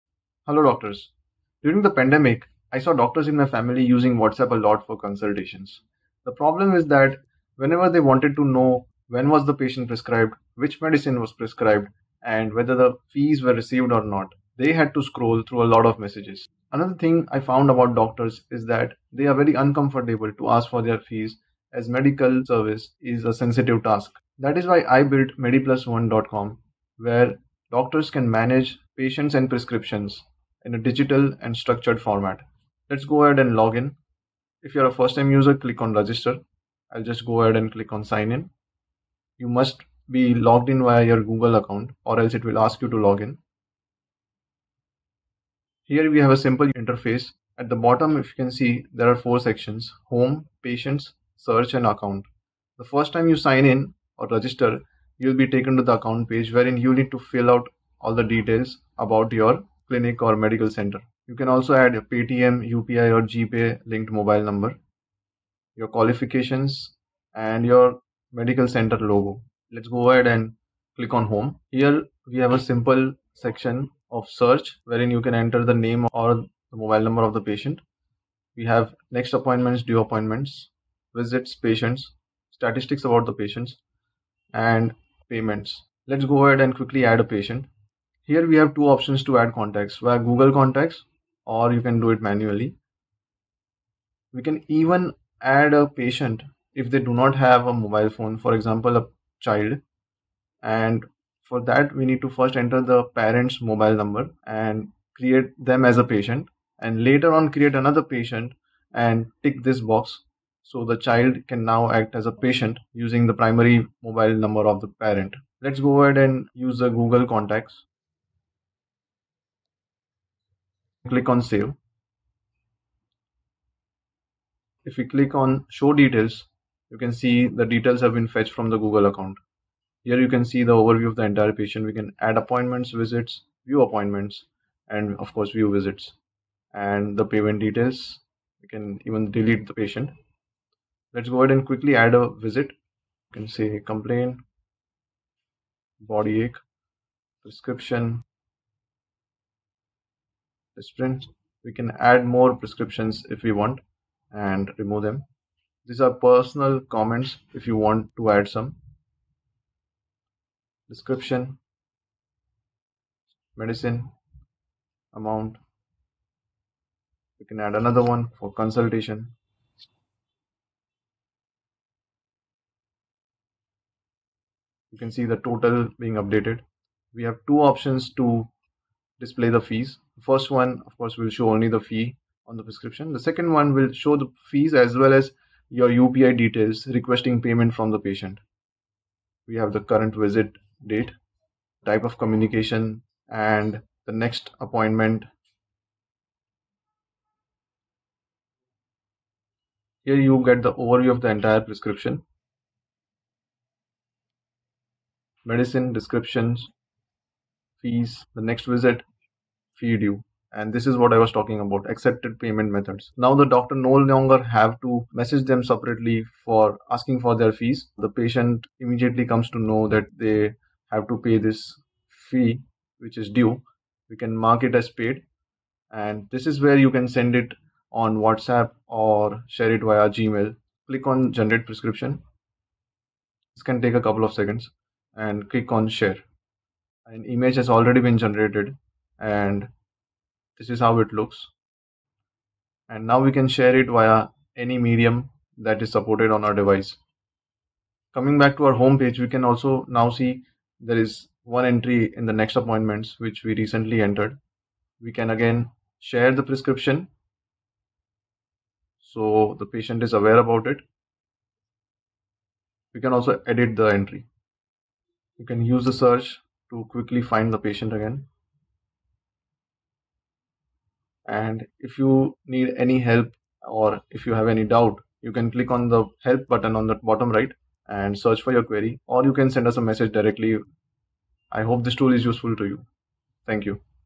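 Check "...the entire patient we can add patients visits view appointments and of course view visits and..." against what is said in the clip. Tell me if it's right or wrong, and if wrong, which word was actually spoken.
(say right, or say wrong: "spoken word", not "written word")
wrong: "appointments", not "patients".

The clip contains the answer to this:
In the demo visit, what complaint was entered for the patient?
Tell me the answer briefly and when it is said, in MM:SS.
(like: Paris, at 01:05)
Body ache, at 02:25.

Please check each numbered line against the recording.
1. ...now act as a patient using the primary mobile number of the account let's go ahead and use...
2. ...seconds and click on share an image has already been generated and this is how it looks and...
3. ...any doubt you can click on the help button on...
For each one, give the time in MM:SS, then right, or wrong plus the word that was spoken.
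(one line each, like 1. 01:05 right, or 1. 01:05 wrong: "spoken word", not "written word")
1. 01:51 wrong: "parent", not "account"
2. 03:54 right
3. 04:34 right.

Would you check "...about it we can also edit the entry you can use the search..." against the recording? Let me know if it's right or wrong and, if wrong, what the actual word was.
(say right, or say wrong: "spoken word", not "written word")
right.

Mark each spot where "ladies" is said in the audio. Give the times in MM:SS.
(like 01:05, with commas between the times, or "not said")
not said.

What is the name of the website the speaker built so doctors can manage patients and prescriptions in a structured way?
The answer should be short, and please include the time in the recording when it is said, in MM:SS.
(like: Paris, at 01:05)
mediplusone.com, at 00:25.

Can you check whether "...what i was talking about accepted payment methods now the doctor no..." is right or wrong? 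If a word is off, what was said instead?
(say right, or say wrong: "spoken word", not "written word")
right.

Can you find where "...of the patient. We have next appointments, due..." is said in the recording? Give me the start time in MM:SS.
01:17.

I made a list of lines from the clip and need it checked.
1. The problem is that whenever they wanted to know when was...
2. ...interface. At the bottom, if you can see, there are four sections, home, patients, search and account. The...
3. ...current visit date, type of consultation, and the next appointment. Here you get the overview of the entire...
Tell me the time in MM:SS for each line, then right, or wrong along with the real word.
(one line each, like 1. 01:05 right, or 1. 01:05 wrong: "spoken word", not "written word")
1. 00:06 right
2. 00:46 right
3. 03:09 wrong: "communication", not "consultation".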